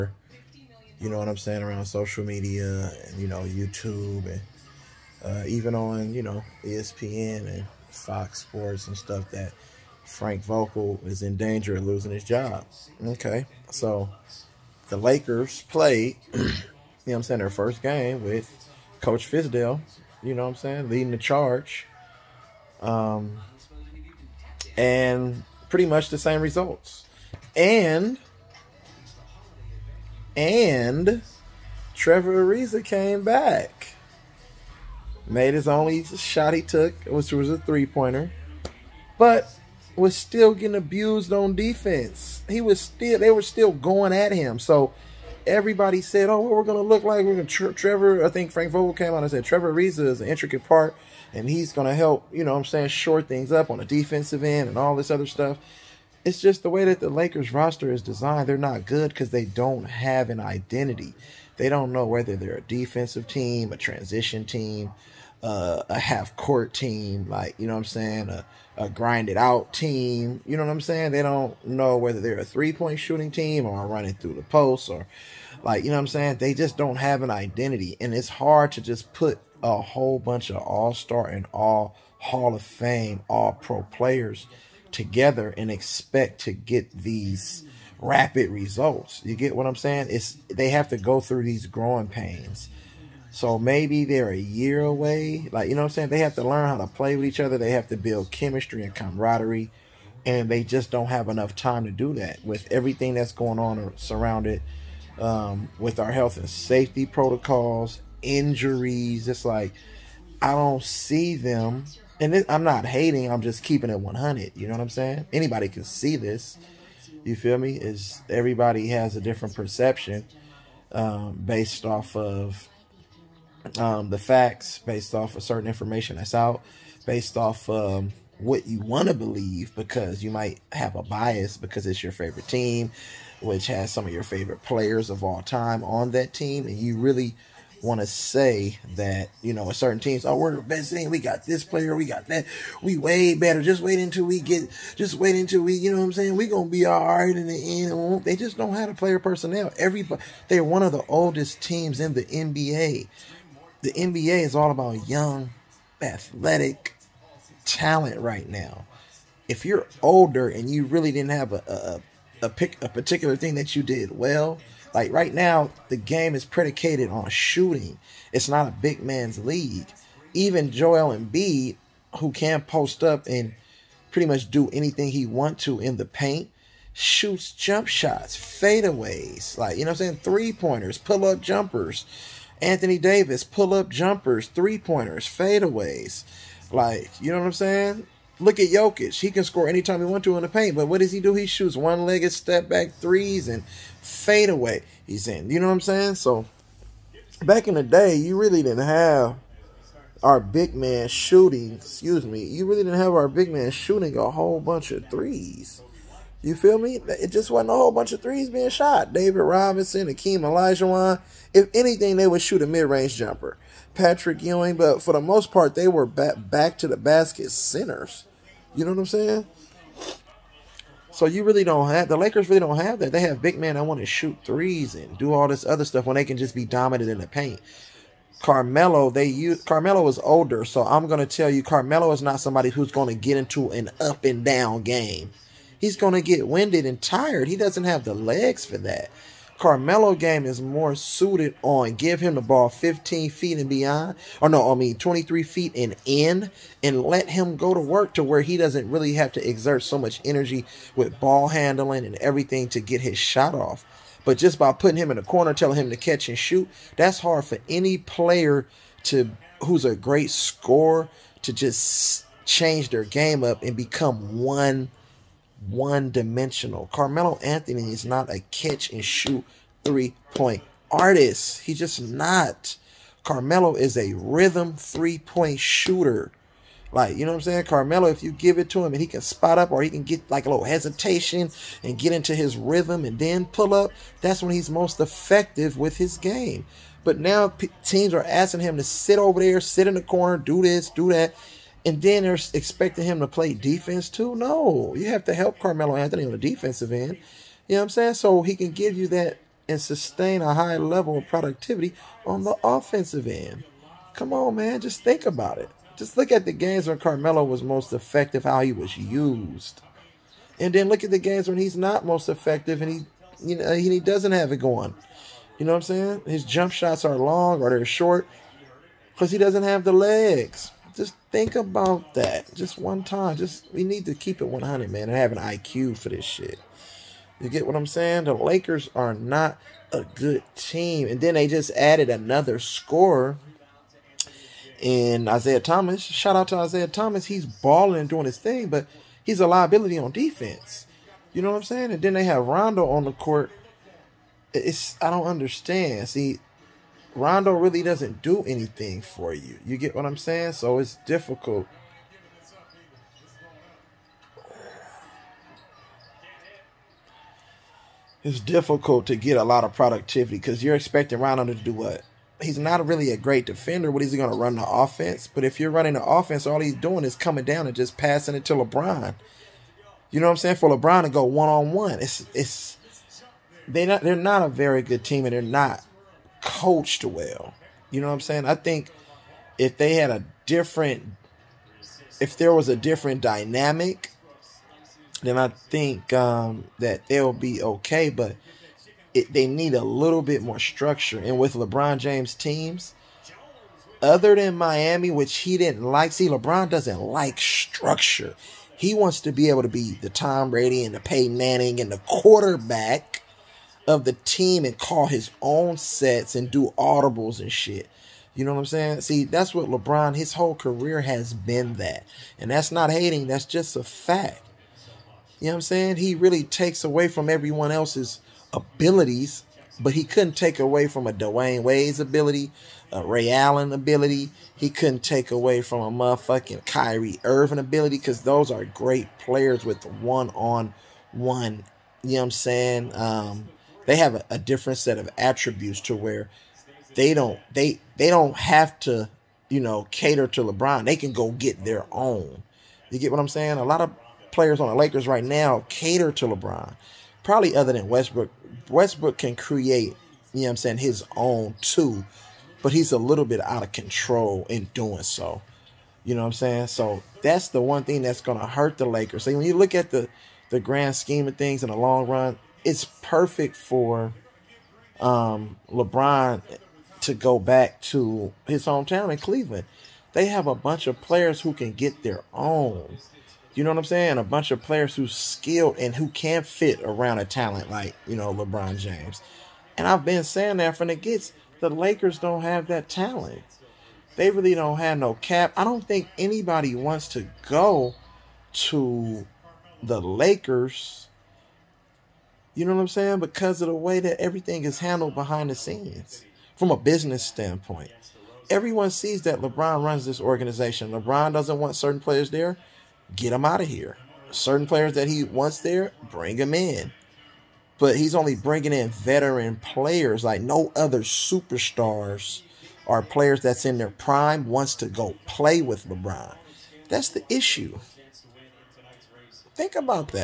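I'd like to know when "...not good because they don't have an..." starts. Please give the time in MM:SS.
00:58.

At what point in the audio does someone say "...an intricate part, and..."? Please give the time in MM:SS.
00:50.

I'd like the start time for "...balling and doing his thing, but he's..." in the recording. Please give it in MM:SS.
05:37.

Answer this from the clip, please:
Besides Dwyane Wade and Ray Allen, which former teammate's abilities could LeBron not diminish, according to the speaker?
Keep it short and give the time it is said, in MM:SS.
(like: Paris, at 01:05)
Kyrie Irving, at 07:06.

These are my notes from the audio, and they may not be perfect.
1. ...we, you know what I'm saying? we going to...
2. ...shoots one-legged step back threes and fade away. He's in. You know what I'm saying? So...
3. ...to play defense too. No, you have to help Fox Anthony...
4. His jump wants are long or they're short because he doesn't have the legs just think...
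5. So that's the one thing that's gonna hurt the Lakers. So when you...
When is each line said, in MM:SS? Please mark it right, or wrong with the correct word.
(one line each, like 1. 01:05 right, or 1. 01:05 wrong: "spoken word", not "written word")
1. 02:25 right
2. 03:11 right
3. 04:53 wrong: "Carmelo", not "Fox"
4. 05:16 wrong: "shots", not "wants"
5. 07:36 right.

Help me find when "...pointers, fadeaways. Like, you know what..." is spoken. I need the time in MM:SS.
03:04.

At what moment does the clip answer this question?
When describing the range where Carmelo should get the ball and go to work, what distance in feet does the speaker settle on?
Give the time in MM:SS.
04:04.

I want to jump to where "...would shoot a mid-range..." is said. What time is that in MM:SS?
03:32.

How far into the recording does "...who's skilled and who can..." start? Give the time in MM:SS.
07:54.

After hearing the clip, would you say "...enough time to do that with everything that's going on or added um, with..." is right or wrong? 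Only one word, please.
wrong.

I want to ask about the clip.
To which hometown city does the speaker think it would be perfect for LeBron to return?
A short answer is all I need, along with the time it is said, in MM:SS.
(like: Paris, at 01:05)
Cleveland, at 07:49.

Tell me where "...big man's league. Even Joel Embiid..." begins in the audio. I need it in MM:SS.
02:48.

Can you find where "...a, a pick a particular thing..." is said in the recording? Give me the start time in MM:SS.
02:42.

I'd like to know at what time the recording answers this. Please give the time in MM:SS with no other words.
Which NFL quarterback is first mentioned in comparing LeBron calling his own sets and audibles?
06:40.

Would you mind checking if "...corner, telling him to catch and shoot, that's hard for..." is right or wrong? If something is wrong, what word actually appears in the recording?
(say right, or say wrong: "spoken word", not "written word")
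right.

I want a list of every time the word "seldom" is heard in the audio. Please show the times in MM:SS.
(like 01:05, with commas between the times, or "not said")
not said.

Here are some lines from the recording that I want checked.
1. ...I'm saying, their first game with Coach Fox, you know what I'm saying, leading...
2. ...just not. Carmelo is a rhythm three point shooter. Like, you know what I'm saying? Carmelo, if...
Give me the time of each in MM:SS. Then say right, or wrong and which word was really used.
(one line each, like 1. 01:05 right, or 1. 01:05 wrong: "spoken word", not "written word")
1. 00:17 wrong: "Fisdale", not "Fox"
2. 04:31 right.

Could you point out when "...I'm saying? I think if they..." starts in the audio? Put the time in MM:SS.
06:18.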